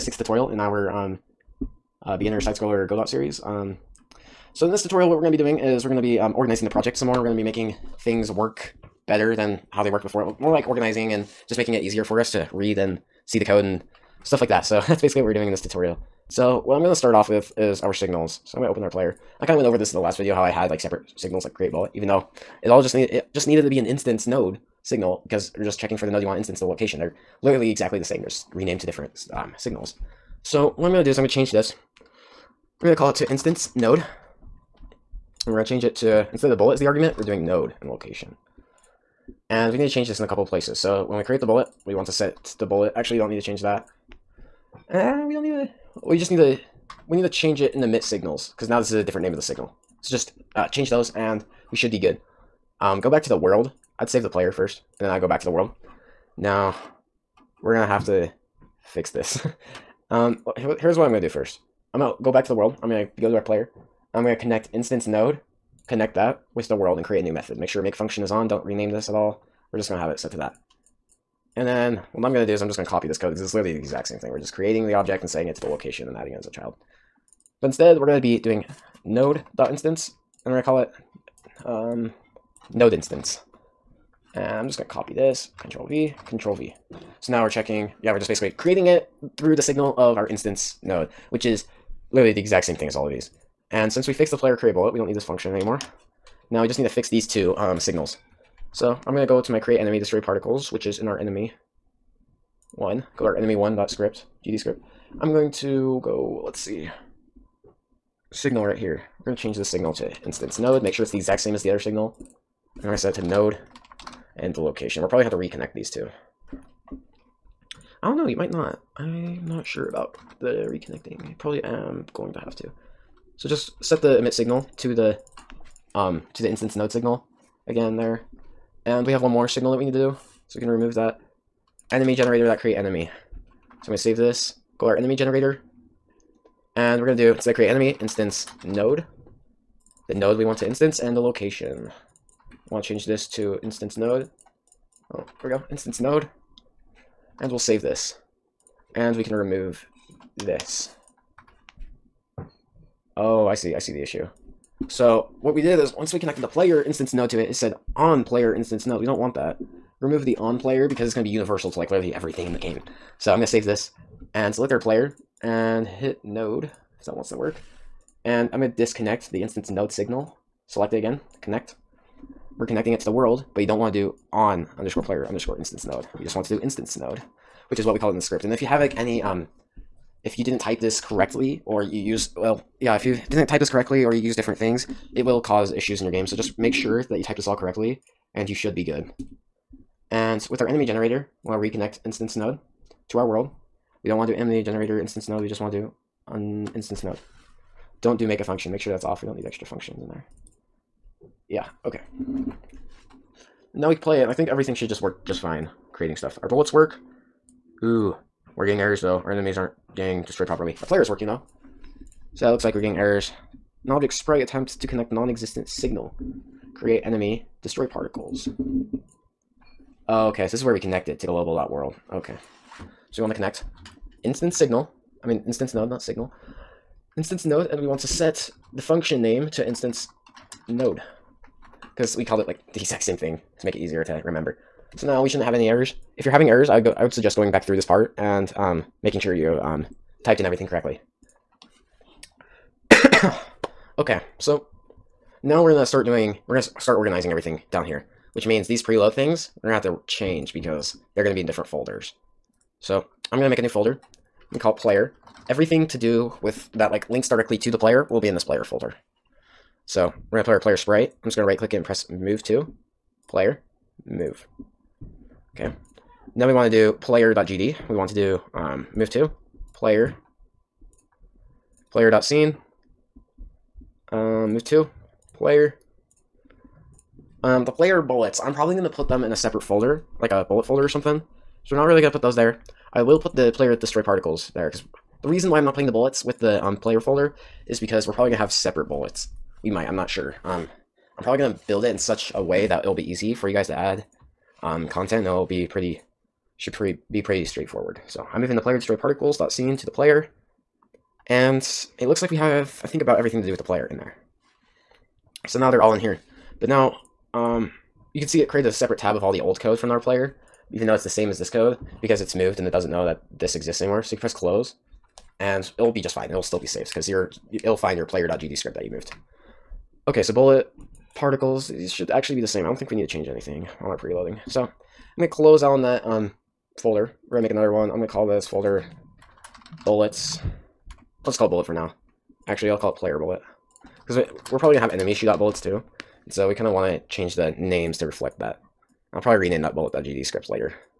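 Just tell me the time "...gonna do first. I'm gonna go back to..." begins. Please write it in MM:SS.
01:01.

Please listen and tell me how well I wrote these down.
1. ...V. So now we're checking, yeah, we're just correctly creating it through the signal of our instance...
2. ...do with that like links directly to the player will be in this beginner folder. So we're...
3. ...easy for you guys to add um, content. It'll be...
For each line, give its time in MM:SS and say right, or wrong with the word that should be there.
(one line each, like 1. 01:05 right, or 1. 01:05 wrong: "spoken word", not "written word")
1. 01:26 wrong: "basically", not "correctly"
2. 04:15 wrong: "player", not "beginner"
3. 04:53 right.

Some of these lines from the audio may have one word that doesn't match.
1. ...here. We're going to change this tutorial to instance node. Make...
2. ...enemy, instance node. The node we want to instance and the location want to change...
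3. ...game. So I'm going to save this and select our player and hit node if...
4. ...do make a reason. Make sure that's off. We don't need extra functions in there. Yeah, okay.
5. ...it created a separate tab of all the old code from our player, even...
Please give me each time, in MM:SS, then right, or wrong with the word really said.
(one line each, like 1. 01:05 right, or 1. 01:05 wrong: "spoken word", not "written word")
1. 01:48 wrong: "signal", not "tutorial"
2. 02:17 right
3. 02:42 right
4. 03:18 wrong: "function", not "reason"
5. 05:08 right.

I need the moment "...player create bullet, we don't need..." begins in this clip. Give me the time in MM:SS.
01:34.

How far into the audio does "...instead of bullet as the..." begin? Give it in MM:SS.
00:36.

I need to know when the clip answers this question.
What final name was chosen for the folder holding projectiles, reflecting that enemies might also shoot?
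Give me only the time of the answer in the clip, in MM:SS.
05:32.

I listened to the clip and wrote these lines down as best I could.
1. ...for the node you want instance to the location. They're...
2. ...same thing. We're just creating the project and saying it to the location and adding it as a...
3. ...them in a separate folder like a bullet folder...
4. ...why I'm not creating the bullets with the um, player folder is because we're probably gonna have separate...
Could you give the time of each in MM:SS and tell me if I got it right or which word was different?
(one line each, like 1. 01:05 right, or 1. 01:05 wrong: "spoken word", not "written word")
1. 00:25 right
2. 01:14 wrong: "object", not "project"
3. 04:39 right
4. 04:45 wrong: "playing", not "creating".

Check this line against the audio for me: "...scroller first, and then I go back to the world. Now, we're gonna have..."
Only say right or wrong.
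wrong.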